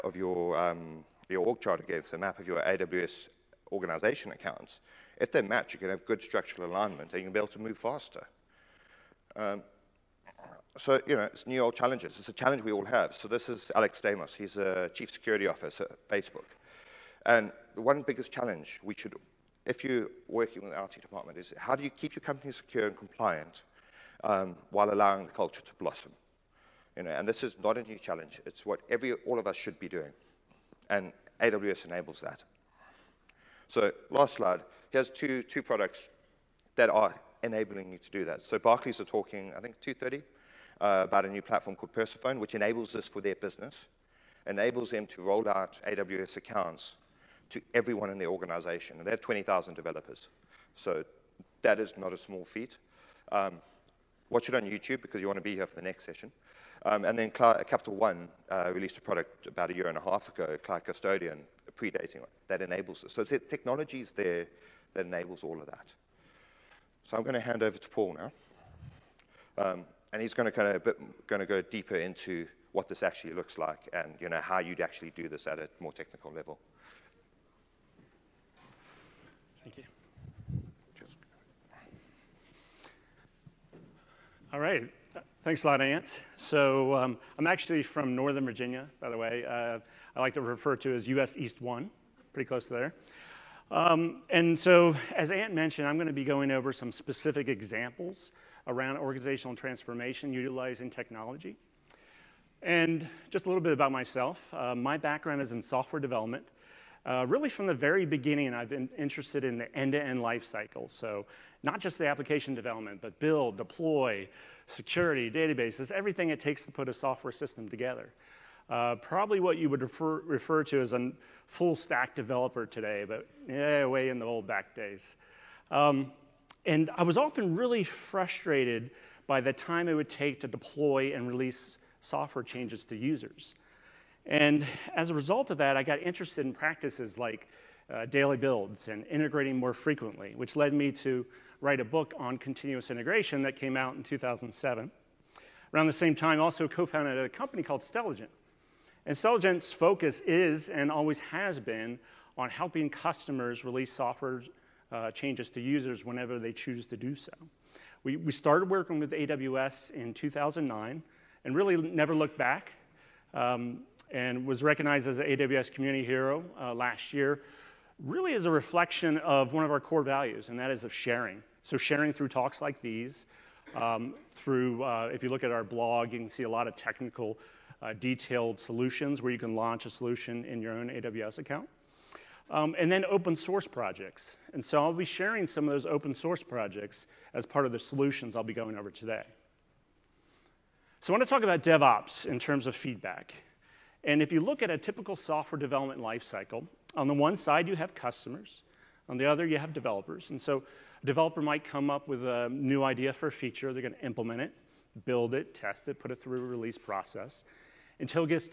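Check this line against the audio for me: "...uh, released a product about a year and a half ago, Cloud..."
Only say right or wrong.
right.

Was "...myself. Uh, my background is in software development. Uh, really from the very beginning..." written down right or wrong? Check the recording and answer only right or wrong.
right.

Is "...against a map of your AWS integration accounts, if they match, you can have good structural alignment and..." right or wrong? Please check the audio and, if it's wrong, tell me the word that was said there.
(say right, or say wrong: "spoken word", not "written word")
wrong: "organization", not "integration".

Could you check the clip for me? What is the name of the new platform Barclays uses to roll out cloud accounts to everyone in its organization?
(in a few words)
Persephone.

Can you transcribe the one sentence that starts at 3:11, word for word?
So I want to talk about DevOps in terms of feedback.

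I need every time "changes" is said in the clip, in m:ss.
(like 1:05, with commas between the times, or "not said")
2:12, 2:35.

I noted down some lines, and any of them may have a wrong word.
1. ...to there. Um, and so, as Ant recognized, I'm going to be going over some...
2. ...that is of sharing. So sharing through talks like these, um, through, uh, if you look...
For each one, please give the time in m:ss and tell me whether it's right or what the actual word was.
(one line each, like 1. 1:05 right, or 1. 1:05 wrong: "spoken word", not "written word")
1. 1:32 wrong: "mentioned", not "recognized"
2. 2:50 right.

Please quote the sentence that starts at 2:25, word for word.
Around the same time, also co-founded a company called Stelligent.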